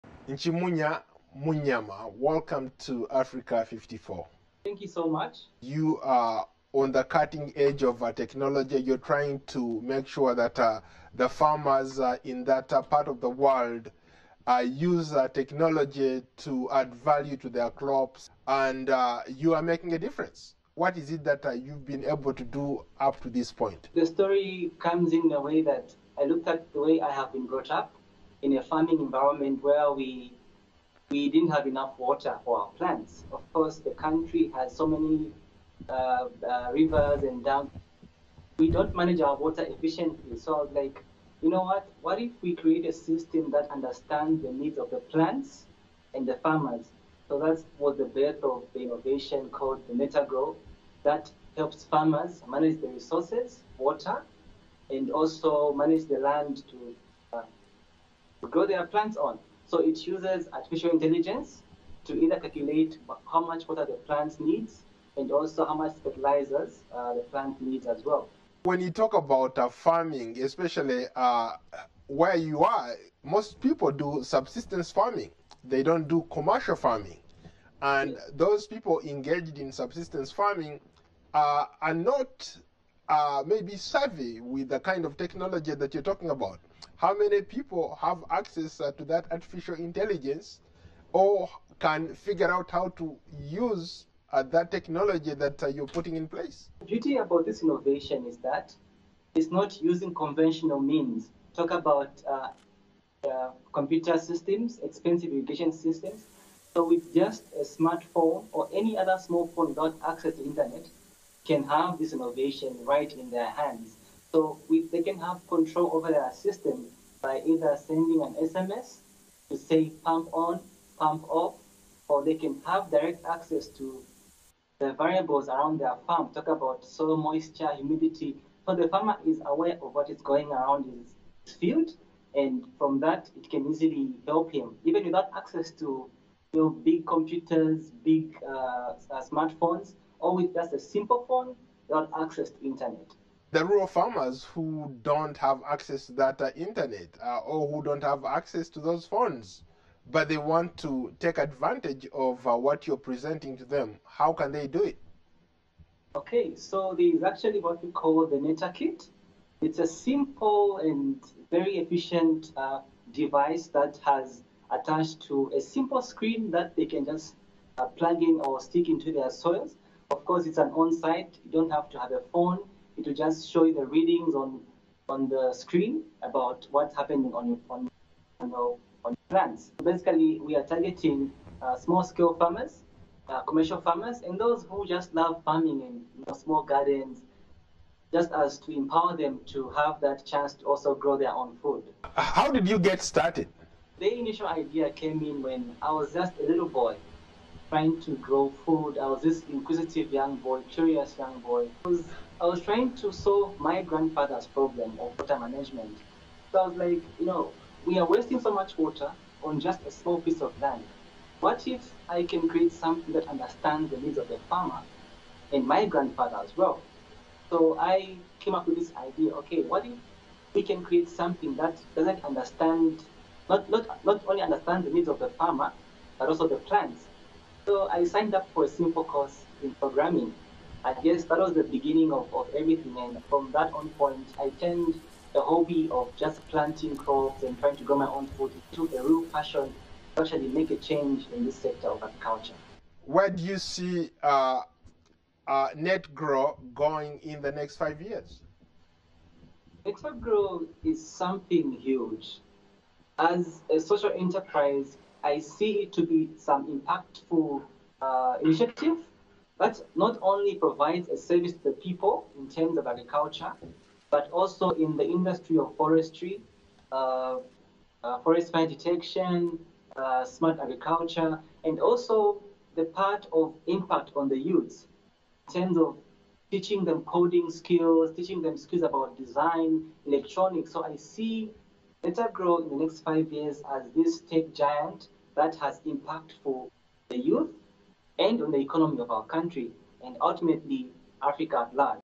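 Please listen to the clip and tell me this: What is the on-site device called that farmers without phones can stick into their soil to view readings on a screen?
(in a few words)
Neta Kit.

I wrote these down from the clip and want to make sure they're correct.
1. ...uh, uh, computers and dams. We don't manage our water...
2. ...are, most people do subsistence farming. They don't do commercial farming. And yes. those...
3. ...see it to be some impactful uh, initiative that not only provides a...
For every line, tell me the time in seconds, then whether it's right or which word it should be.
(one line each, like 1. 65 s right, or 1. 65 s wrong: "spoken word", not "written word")
1. 35 s wrong: "rivers", not "computers"
2. 72 s right
3. 255 s right.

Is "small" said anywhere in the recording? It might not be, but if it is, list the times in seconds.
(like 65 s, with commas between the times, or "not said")
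109 s, 181 s, 186 s, 209 s.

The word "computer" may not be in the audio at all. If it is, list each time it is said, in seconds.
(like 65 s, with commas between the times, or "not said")
103 s, 137 s.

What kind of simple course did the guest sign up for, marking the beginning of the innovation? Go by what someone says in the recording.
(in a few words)
Programming.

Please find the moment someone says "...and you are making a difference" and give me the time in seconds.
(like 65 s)
18 s.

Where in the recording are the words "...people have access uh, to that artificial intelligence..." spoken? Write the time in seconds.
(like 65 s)
87 s.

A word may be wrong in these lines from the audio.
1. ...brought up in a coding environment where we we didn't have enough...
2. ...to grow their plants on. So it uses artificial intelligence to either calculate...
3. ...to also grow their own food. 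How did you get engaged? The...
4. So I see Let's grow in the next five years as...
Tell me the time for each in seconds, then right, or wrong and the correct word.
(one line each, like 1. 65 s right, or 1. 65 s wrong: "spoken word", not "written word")
1. 27 s wrong: "farming", not "coding"
2. 56 s right
3. 190 s wrong: "started", not "engaged"
4. 280 s right.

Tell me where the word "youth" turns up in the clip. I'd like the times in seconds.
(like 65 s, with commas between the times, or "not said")
274 s, 287 s.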